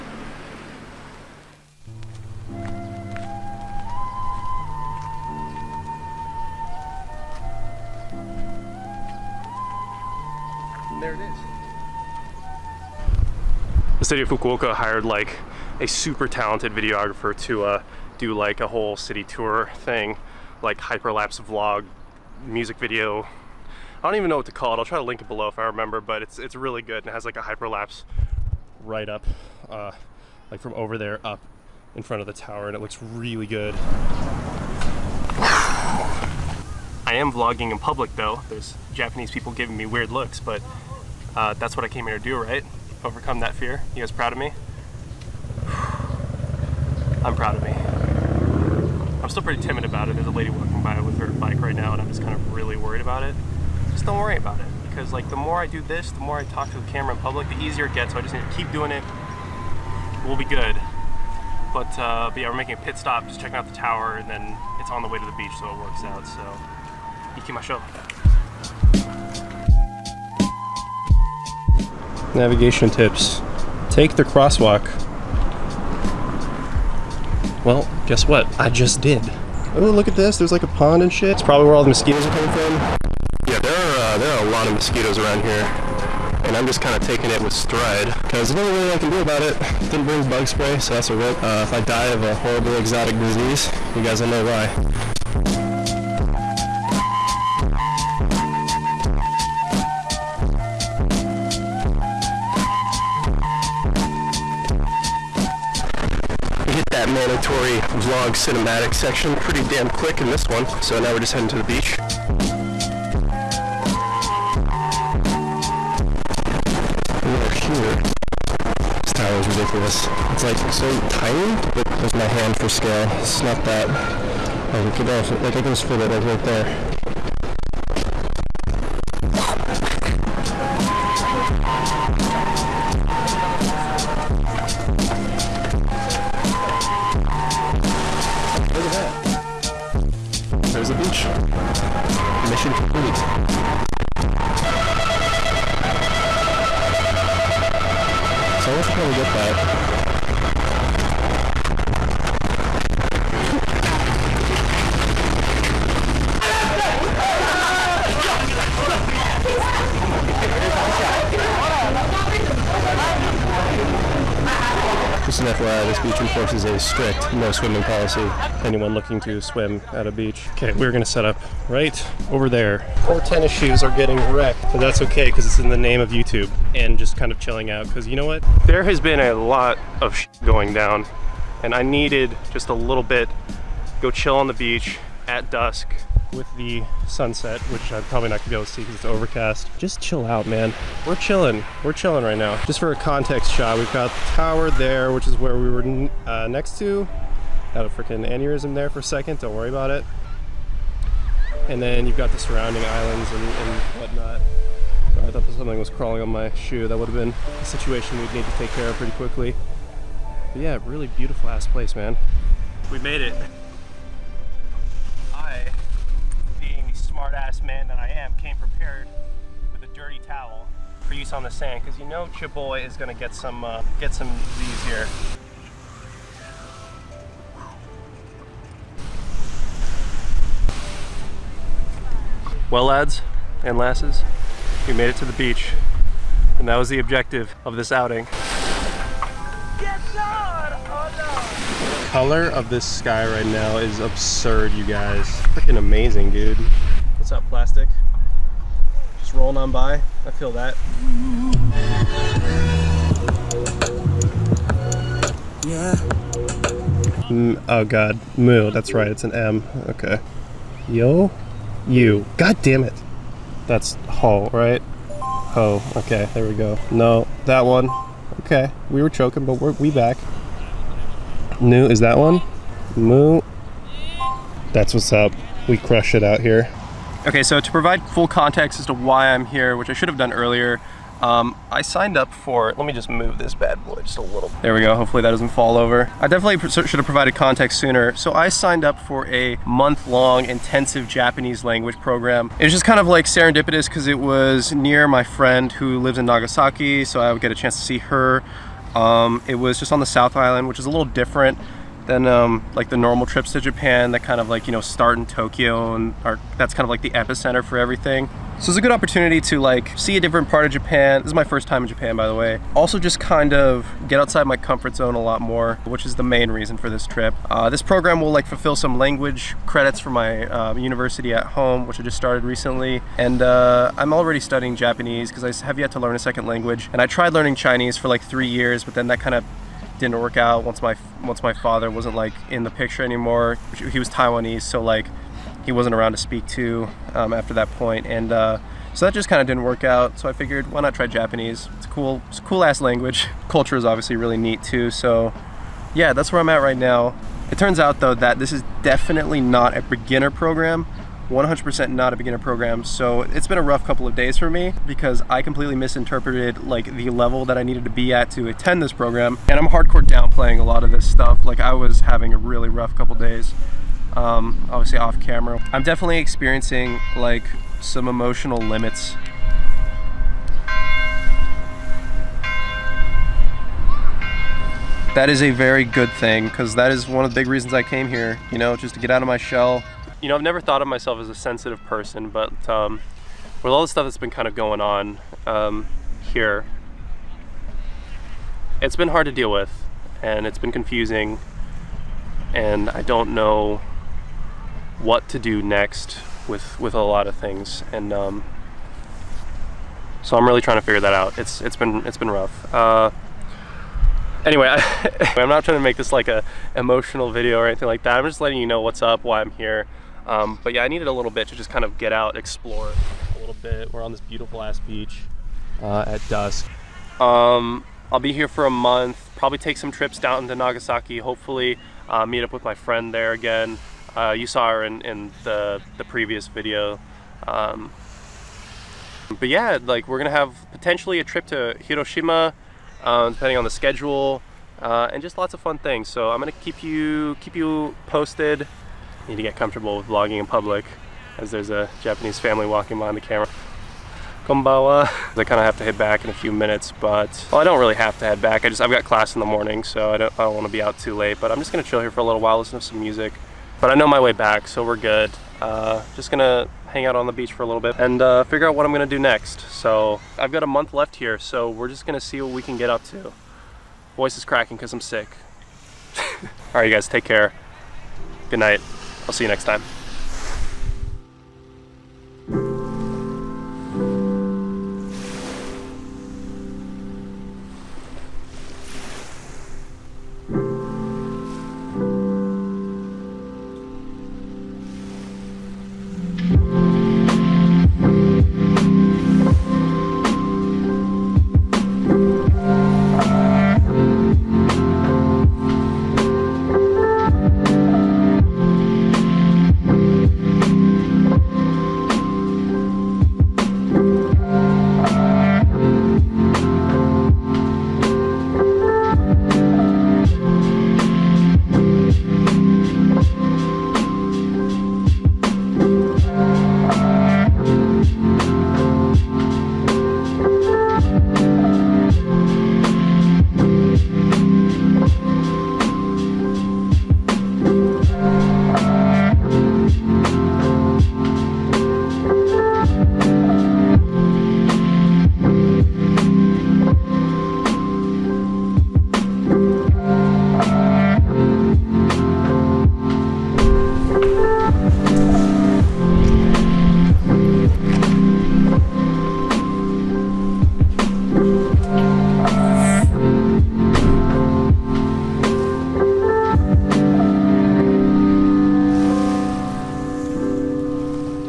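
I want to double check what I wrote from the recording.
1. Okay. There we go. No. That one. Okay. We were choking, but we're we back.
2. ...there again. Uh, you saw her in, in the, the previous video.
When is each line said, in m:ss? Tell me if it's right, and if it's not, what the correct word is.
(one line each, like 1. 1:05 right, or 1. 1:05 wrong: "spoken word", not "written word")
1. 4:25 right
2. 7:03 right.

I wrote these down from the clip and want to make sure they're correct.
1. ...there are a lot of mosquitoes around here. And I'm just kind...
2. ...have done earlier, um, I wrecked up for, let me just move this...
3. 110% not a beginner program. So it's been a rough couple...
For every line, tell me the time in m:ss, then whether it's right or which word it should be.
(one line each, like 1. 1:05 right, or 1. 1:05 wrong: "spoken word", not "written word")
1. 1:24 right
2. 4:40 wrong: "signed", not "wrecked"
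3. 5:51 wrong: "100", not "110".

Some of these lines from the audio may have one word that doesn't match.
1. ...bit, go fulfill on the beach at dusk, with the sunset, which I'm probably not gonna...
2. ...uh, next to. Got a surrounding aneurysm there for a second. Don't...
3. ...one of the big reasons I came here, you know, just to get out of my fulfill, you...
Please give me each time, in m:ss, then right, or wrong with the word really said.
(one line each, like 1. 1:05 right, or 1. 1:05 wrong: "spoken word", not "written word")
1. 3:03 wrong: "chill", not "fulfill"
2. 3:16 wrong: "freaking", not "surrounding"
3. 6:17 wrong: "shell", not "fulfill".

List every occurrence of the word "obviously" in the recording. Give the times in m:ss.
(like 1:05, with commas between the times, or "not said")
5:43, 6:04.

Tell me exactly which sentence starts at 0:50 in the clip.
There's a lady walking by with her bike right now, and I'm just kind of really worried about it.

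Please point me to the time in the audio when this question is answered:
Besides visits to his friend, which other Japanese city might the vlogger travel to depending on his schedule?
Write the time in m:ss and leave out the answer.
7:11.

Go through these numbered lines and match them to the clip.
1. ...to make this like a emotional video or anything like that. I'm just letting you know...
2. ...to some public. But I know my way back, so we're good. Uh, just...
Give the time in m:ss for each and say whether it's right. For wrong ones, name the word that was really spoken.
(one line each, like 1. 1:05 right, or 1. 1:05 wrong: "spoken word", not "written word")
1. 6:45 right
2. 7:32 wrong: "music", not "public".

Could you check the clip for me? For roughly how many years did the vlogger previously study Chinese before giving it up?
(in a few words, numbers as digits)
3 years.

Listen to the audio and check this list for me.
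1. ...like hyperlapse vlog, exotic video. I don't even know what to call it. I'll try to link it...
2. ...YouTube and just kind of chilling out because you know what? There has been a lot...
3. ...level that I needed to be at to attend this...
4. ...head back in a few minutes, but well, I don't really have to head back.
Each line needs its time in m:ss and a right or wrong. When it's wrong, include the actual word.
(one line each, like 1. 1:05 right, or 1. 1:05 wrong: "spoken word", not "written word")
1. 0:20 wrong: "music", not "exotic"
2. 2:56 right
3. 5:57 right
4. 7:25 right.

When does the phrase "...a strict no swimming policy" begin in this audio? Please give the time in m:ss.
2:46.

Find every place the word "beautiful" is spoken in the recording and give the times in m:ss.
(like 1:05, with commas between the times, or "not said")
3:31, 6:54.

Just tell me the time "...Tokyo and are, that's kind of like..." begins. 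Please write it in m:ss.
5:05.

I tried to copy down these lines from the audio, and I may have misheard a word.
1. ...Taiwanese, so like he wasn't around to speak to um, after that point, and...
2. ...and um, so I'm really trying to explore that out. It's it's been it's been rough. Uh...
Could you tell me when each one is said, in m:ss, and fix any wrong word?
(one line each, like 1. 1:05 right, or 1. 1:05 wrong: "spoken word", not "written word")
1. 5:34 right
2. 6:37 wrong: "figure", not "explore".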